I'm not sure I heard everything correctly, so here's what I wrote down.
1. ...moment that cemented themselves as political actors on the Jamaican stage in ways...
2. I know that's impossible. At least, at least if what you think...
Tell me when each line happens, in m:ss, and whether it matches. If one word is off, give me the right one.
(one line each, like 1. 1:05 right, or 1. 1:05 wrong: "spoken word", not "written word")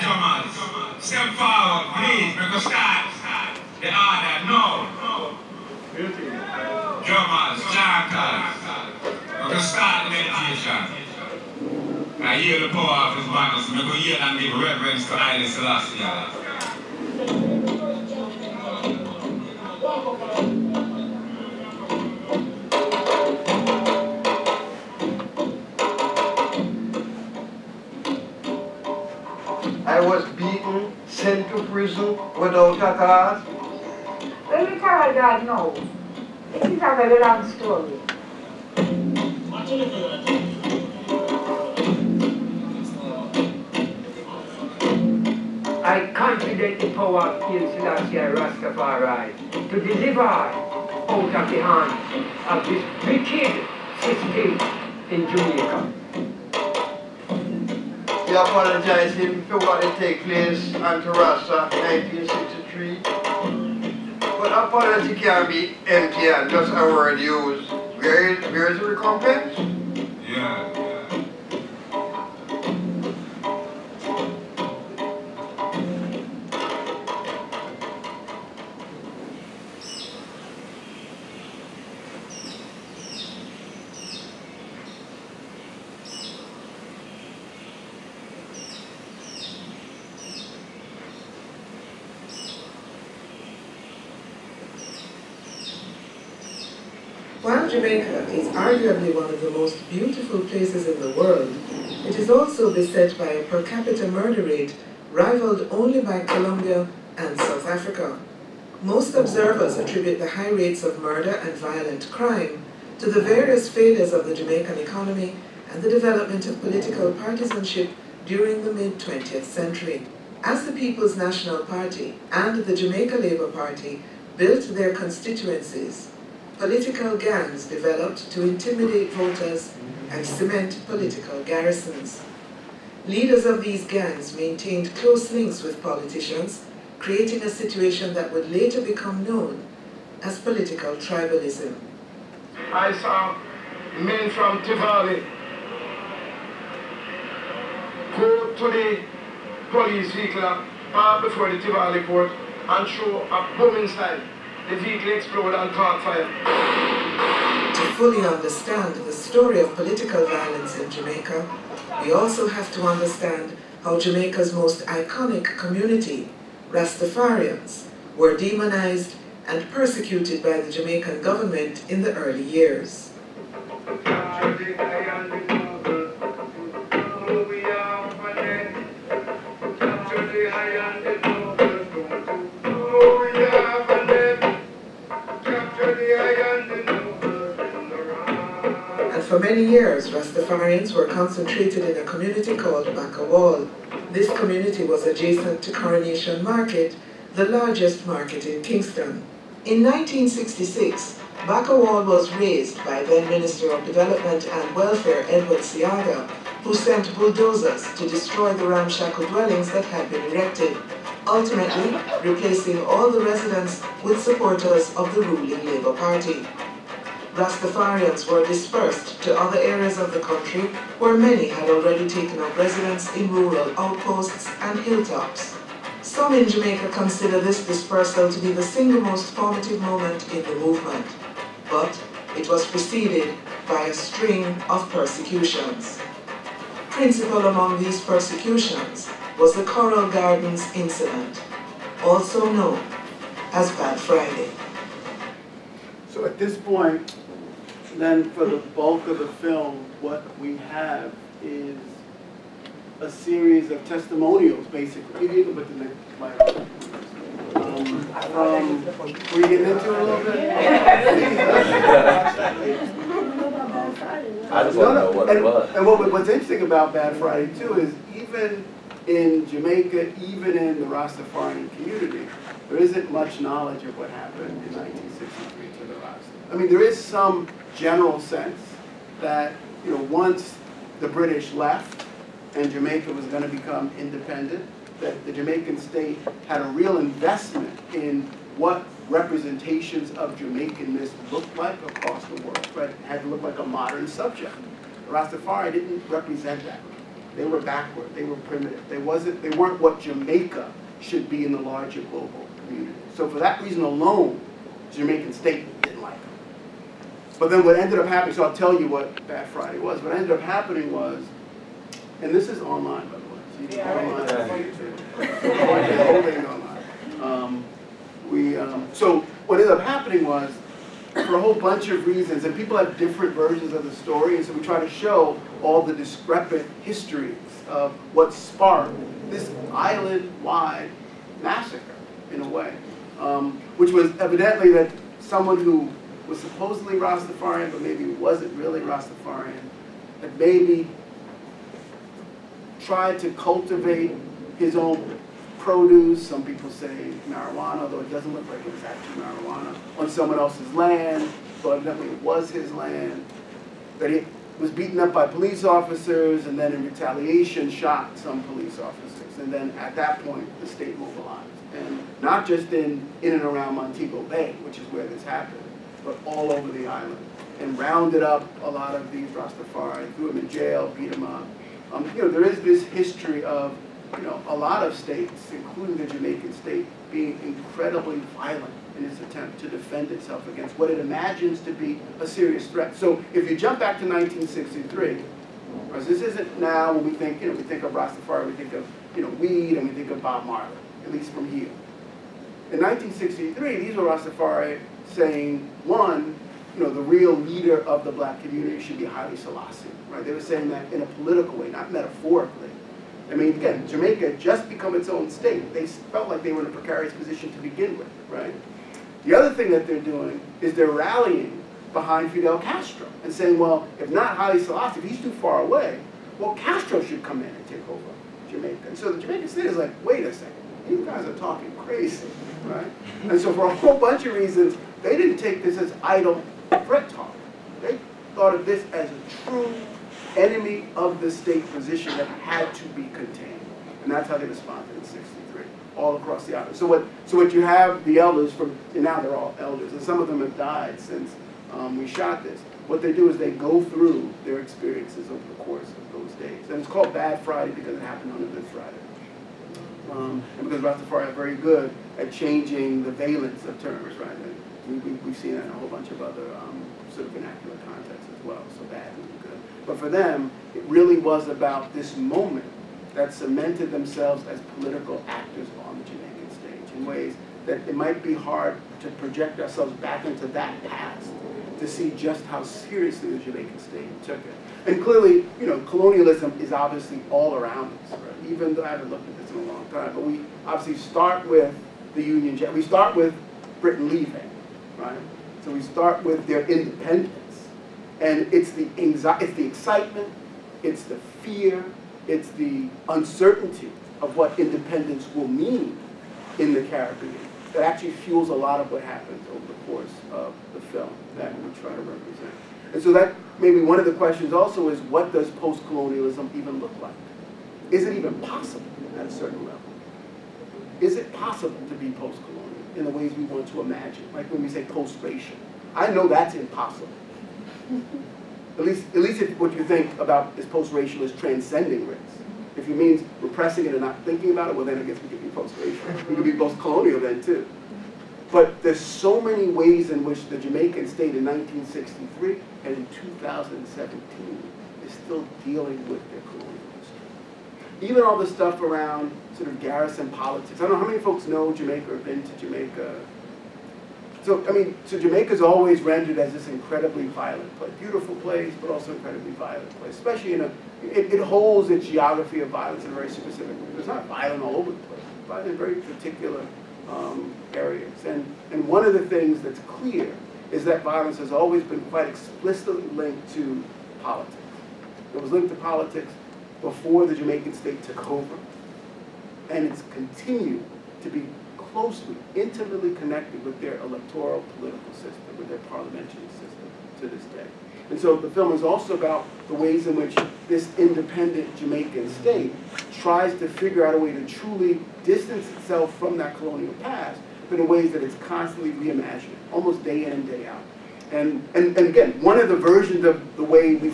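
1. 7:42 right
2. 8:35 right.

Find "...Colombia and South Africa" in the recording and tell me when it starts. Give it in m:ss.
1:46.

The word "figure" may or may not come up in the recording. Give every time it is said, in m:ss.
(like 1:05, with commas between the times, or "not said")
9:43.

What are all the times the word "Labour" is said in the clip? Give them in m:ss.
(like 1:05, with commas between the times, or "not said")
2:03, 3:35.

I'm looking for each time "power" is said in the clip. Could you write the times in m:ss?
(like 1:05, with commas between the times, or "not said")
0:12, 0:46.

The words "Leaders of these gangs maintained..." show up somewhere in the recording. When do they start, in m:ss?
2:13.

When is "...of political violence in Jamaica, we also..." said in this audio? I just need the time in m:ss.
2:39.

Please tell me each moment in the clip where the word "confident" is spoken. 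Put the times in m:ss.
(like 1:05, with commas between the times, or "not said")
0:46.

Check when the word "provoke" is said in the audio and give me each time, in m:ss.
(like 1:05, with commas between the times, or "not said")
not said.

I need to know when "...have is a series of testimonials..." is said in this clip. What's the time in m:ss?
4:10.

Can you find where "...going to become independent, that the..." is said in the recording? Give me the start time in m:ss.
4:43.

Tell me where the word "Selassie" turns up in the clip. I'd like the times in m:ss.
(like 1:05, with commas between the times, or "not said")
0:15, 0:47, 6:39, 6:54.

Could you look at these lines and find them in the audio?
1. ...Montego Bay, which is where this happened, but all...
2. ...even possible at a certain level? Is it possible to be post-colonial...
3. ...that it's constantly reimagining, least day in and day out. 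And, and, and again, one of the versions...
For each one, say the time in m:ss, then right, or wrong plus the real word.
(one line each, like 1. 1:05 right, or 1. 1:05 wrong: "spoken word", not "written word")
1. 6:03 right
2. 8:28 right
3. 9:48 wrong: "almost", not "least".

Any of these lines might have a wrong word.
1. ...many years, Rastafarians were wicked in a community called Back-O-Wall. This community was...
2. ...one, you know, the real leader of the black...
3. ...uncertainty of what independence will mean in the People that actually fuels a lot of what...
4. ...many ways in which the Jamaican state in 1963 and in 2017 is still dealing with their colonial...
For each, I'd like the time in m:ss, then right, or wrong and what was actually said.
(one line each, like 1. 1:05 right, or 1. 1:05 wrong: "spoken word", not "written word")
1. 3:09 wrong: "concentrated", not "wicked"
2. 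6:35 right
3. 8:13 wrong: "Caribbean", not "People"
4. 8:49 right.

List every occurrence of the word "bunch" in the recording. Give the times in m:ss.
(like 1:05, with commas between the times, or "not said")
5:21, 7:03, 7:35.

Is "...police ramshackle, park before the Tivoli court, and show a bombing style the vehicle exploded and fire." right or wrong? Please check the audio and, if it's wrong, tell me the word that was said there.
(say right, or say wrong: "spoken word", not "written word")
wrong: "vehicle", not "ramshackle".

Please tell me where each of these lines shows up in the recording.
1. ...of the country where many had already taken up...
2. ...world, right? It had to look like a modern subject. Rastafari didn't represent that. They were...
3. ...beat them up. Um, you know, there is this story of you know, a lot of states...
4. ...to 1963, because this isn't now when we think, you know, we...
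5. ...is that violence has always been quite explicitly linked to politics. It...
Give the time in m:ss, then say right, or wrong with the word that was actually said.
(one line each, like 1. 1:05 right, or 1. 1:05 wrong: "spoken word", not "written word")
1. 3:39 right
2. 4:52 right
3. 6:10 wrong: "history", not "story"
4. 6:23 right
5. 9:20 right.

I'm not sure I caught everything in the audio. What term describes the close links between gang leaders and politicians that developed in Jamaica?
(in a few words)
political tribalism.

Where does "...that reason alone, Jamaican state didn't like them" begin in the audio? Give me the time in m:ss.
5:03.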